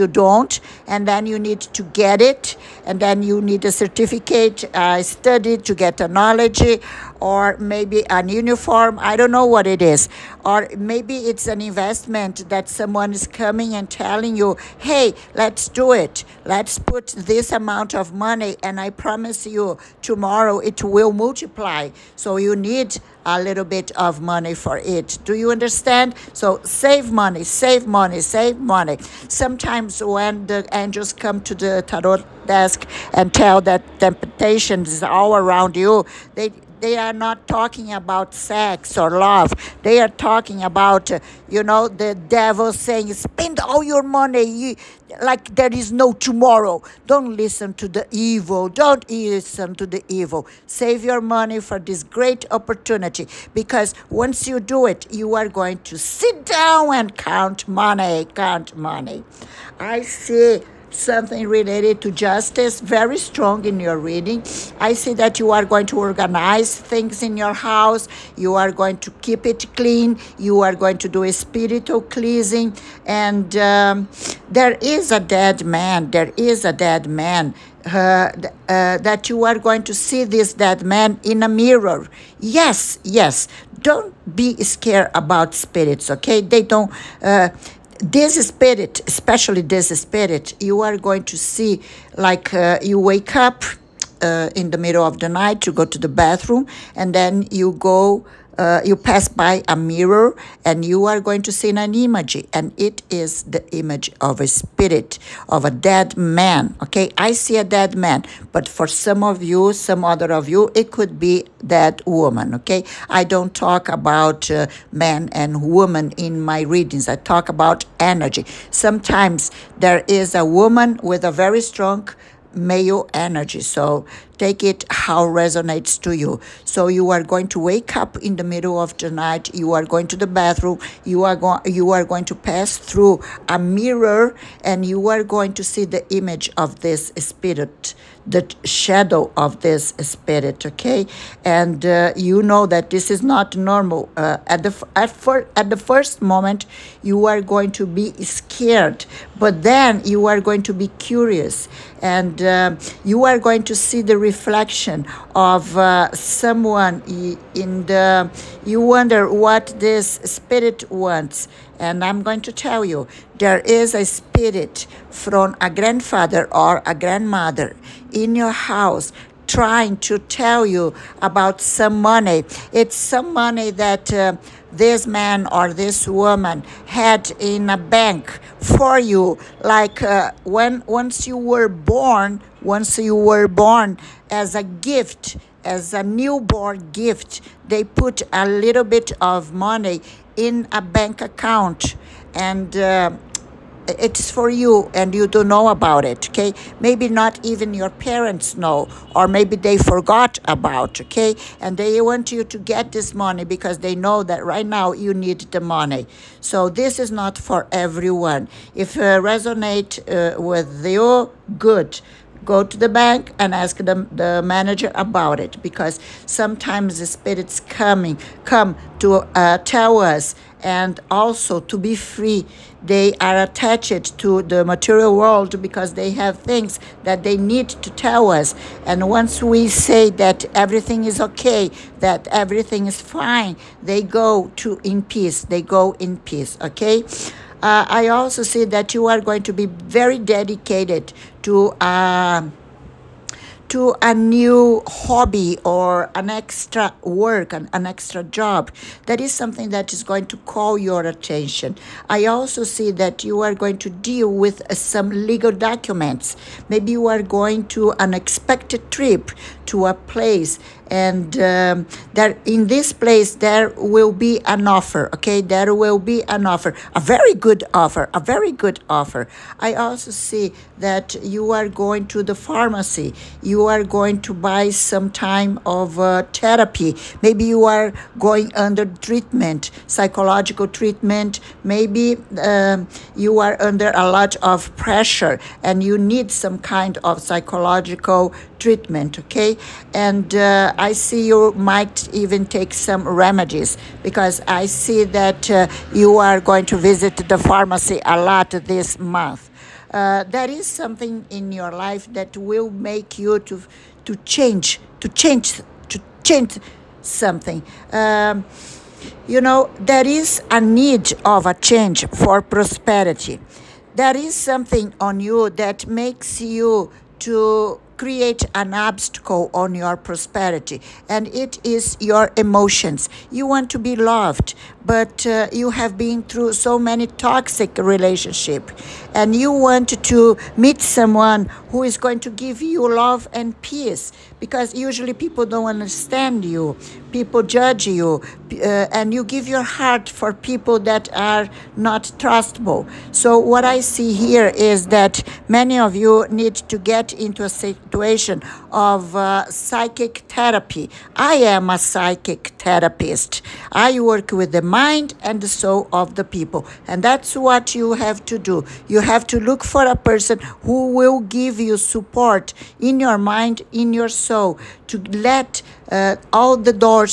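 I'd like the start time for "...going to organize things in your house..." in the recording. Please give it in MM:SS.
01:05.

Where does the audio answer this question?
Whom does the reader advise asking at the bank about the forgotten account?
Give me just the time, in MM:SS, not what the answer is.
03:34.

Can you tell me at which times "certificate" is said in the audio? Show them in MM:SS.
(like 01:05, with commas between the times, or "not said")
00:03.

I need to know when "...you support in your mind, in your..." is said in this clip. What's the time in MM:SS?
06:01.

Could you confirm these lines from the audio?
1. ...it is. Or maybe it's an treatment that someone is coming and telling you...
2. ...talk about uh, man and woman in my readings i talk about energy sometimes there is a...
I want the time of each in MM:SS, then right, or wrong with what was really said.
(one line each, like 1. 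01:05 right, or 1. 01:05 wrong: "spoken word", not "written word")
1. 00:09 wrong: "investment", not "treatment"
2. 01:53 right.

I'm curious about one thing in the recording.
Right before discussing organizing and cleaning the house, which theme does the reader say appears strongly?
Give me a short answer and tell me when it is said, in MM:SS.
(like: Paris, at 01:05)
Justice, at 01:02.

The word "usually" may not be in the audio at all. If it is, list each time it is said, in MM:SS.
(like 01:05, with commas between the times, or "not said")
05:34.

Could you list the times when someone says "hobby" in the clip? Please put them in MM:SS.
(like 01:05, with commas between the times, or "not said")
04:04.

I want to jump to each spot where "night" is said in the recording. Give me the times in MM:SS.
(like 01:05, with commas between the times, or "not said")
01:35, 02:09.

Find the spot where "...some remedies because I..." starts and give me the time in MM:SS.
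04:52.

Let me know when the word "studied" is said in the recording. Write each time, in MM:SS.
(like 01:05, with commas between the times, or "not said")
00:05.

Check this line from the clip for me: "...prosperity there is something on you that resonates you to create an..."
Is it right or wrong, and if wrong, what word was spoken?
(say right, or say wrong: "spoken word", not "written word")
wrong: "makes", not "resonates".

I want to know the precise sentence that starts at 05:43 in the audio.
So, what I see here is that many of you need to get into a situation of uh, psychic therapy.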